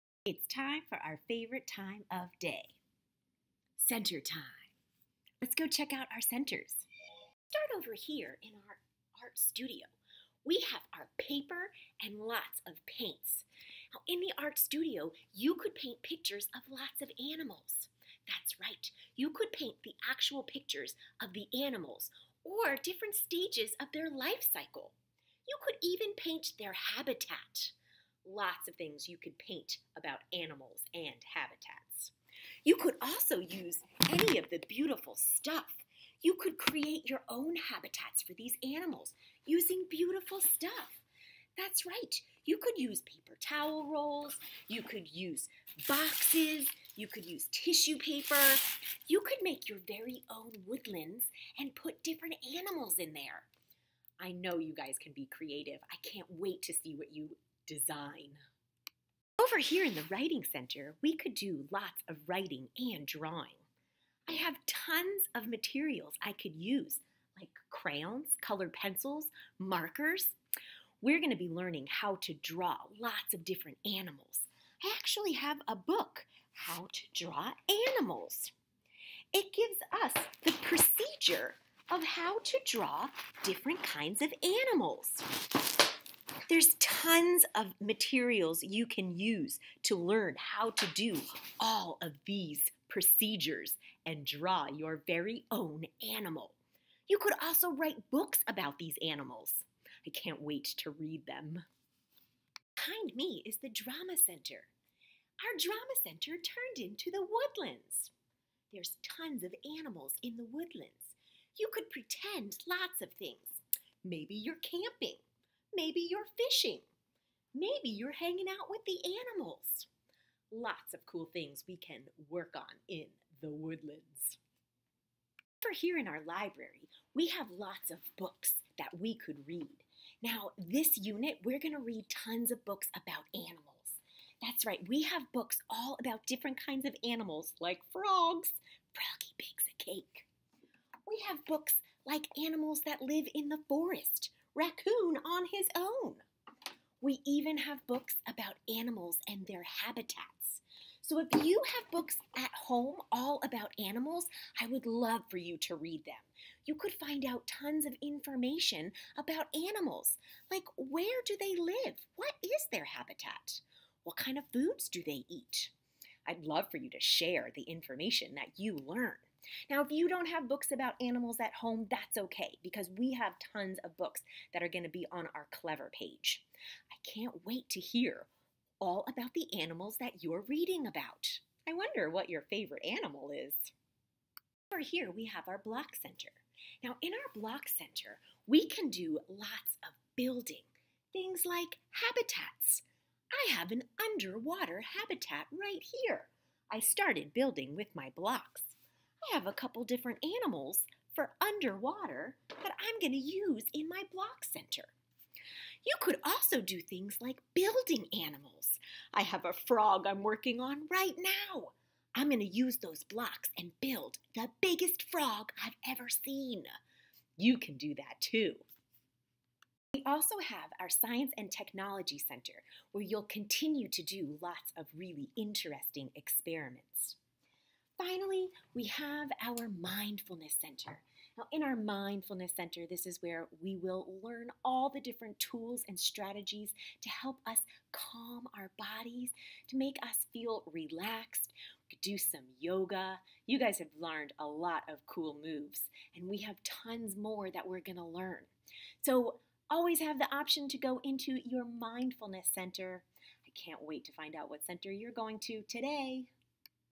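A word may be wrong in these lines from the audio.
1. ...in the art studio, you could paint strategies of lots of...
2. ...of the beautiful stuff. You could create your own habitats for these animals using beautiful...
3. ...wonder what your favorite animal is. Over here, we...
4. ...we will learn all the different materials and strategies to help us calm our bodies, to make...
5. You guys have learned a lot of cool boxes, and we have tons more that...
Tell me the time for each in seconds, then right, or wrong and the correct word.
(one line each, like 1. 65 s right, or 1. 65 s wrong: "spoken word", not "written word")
1. 14 s wrong: "pictures", not "strategies"
2. 34 s right
3. 181 s right
4. 233 s wrong: "tools", not "materials"
5. 243 s wrong: "moves", not "boxes".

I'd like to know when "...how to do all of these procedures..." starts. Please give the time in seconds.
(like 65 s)
90 s.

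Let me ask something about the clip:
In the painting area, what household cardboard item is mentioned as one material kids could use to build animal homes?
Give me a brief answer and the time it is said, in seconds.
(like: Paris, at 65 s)
paper towel rolls, at 43 s.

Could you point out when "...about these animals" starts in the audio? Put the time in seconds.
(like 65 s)
98 s.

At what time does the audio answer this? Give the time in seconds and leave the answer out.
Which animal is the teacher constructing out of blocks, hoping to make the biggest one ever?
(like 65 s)
209 s.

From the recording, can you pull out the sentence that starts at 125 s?
For here in our library, we have lots of books that we could read.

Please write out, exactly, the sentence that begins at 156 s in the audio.
You could find out tons of information about animals, like where do they live?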